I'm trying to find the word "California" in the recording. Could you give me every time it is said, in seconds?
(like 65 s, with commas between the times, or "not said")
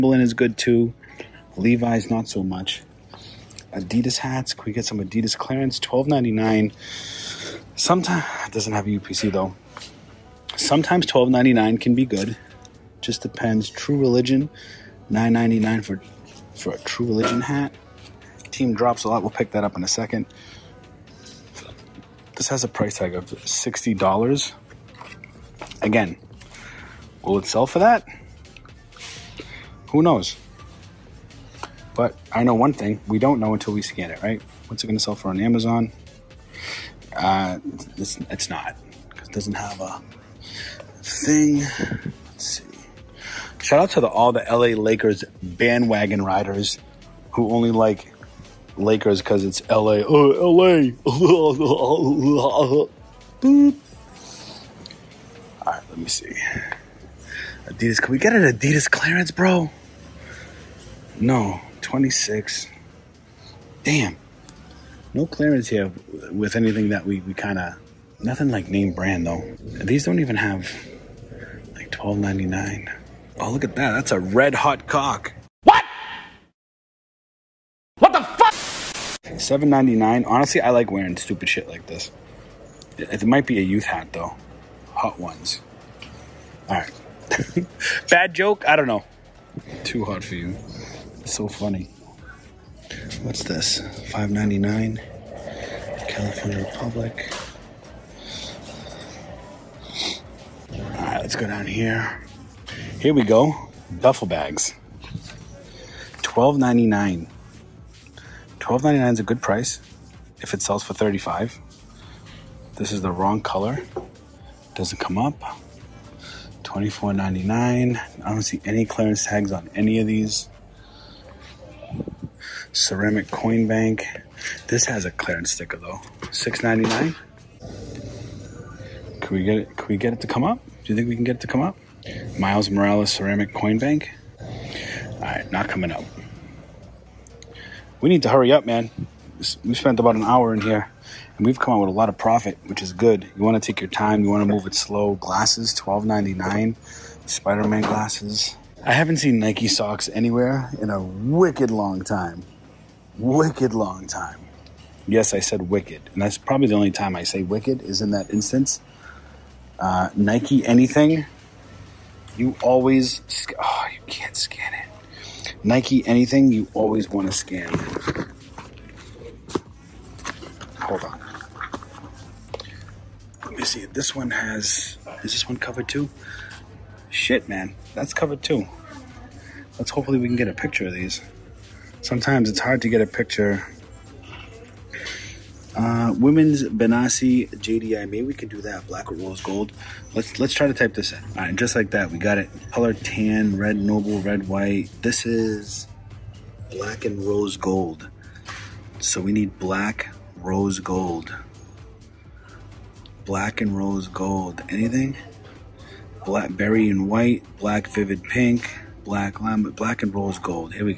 96 s.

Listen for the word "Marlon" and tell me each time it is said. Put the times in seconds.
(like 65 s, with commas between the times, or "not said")
not said.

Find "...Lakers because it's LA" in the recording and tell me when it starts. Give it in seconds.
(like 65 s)
48 s.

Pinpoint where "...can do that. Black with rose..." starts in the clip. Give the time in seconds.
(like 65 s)
188 s.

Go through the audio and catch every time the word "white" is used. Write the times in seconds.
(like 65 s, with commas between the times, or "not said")
194 s, 207 s.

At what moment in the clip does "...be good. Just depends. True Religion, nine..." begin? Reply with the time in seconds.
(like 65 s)
11 s.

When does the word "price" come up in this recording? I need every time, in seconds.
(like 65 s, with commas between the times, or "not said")
22 s, 109 s.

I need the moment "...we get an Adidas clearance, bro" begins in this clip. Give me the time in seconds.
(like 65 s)
58 s.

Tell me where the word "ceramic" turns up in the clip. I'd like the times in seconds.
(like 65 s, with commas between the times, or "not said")
122 s, 133 s.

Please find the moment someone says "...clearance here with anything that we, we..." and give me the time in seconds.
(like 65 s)
65 s.